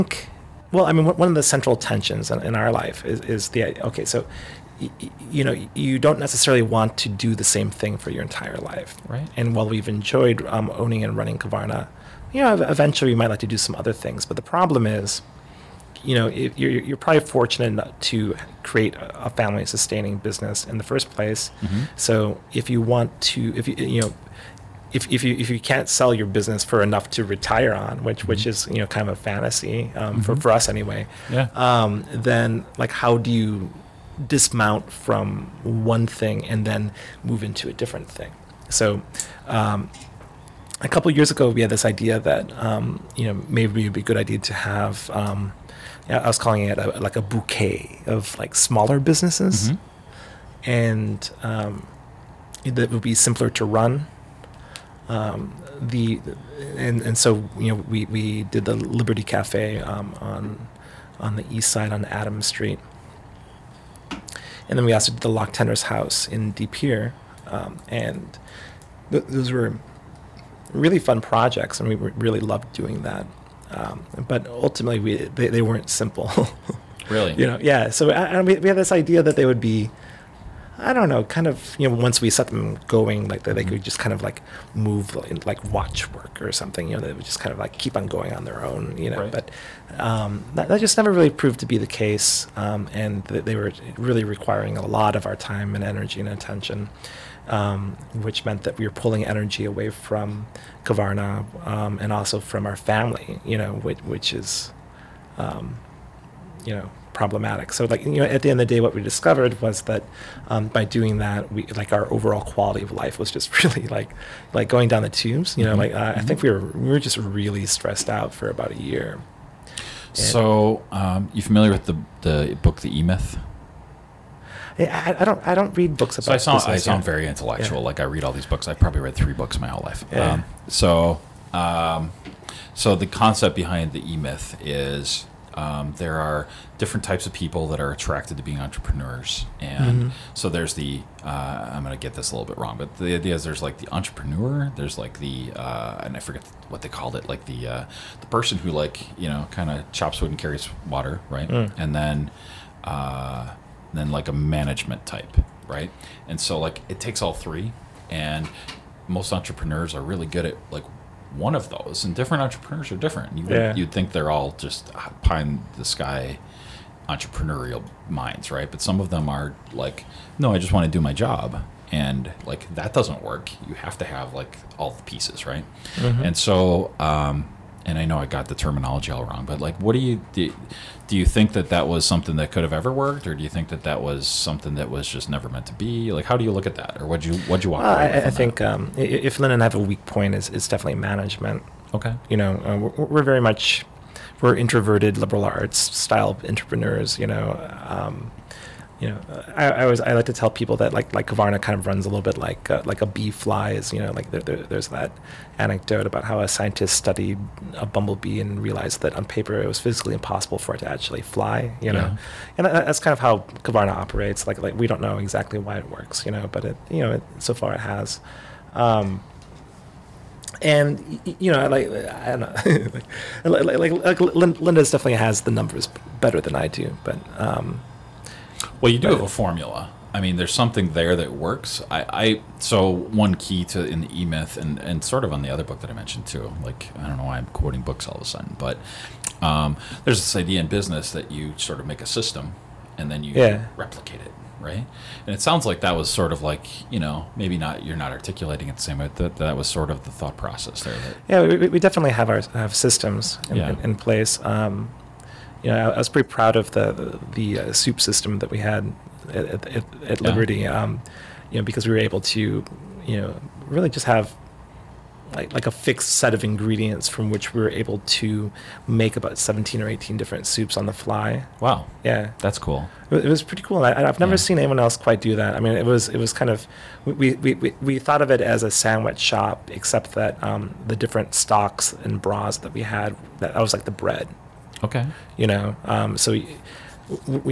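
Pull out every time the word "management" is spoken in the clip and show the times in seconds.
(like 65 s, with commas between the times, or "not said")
154 s, 191 s.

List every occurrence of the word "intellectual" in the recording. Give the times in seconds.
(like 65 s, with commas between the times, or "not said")
127 s.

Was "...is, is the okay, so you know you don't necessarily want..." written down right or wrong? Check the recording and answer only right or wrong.
right.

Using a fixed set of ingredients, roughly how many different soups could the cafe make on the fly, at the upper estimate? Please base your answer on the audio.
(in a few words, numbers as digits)
18.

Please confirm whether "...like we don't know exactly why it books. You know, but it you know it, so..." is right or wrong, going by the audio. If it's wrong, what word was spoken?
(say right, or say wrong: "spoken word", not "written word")
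wrong: "works", not "books".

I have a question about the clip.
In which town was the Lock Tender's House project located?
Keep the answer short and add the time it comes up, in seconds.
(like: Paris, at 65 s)
De Pere, at 66 s.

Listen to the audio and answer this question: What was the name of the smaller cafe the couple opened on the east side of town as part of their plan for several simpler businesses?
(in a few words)
Liberty Cafe.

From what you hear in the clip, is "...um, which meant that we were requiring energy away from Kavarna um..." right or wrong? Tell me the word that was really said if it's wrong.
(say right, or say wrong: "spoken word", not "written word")
wrong: "pulling", not "requiring".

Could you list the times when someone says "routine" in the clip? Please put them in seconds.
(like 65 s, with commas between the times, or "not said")
not said.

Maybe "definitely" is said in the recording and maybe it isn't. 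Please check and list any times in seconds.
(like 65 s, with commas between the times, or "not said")
190 s, 224 s, 251 s.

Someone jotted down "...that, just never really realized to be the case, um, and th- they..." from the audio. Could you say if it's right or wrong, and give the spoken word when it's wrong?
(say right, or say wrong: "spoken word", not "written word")
wrong: "proved", not "realized".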